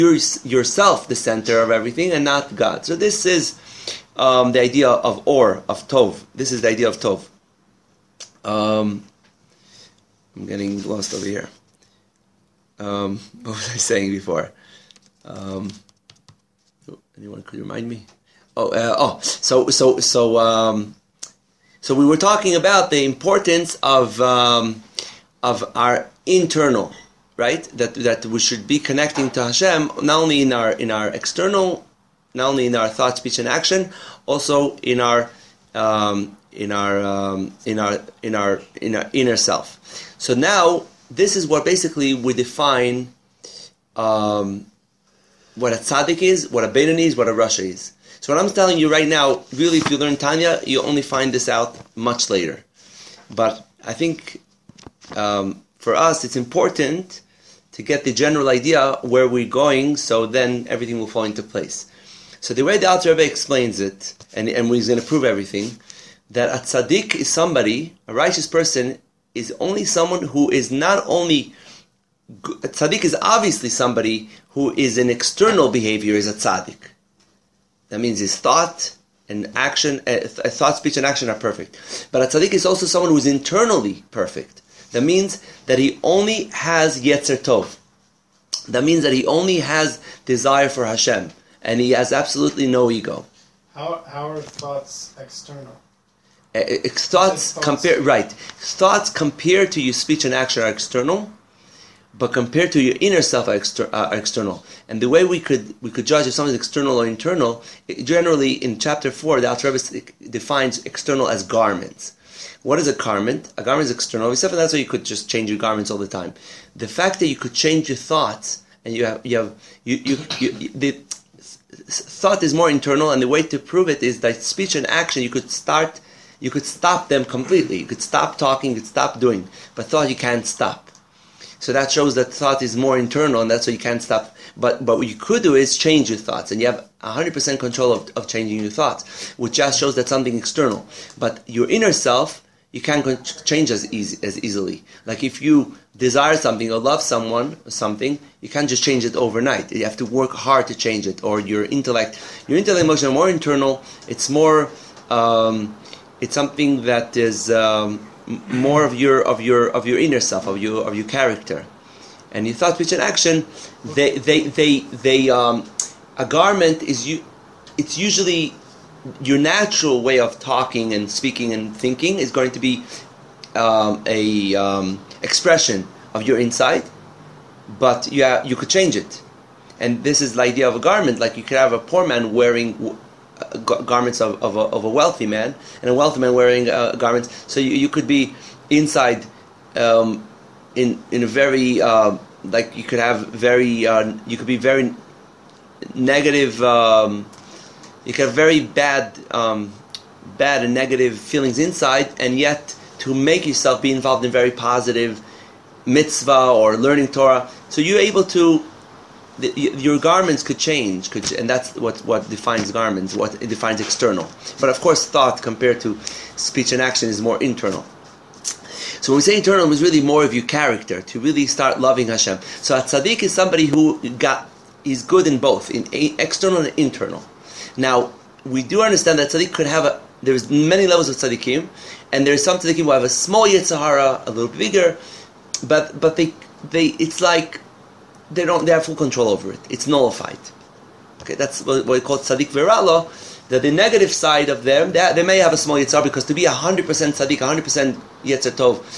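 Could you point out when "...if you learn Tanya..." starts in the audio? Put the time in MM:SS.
00:49.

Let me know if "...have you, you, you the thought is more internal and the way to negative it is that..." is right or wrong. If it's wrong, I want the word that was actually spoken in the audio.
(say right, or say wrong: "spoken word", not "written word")
wrong: "prove", not "negative".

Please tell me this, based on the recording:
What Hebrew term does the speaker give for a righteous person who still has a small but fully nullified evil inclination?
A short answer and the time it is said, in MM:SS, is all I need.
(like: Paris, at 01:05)
tzaddik v'ra lo, at 04:02.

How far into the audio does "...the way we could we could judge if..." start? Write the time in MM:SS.
01:45.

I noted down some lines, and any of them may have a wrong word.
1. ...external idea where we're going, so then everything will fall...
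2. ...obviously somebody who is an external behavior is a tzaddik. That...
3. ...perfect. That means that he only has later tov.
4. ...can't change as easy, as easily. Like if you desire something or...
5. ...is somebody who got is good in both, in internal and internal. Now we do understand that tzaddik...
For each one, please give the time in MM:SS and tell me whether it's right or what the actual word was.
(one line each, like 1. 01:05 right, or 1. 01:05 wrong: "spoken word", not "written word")
1. 00:58 wrong: "general", not "external"
2. 01:13 right
3. 01:24 wrong: "yetzer", not "later"
4. 02:22 right
5. 03:43 wrong: "external", not "internal".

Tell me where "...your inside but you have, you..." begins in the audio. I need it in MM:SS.
02:56.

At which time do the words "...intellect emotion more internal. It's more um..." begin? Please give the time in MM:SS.
02:32.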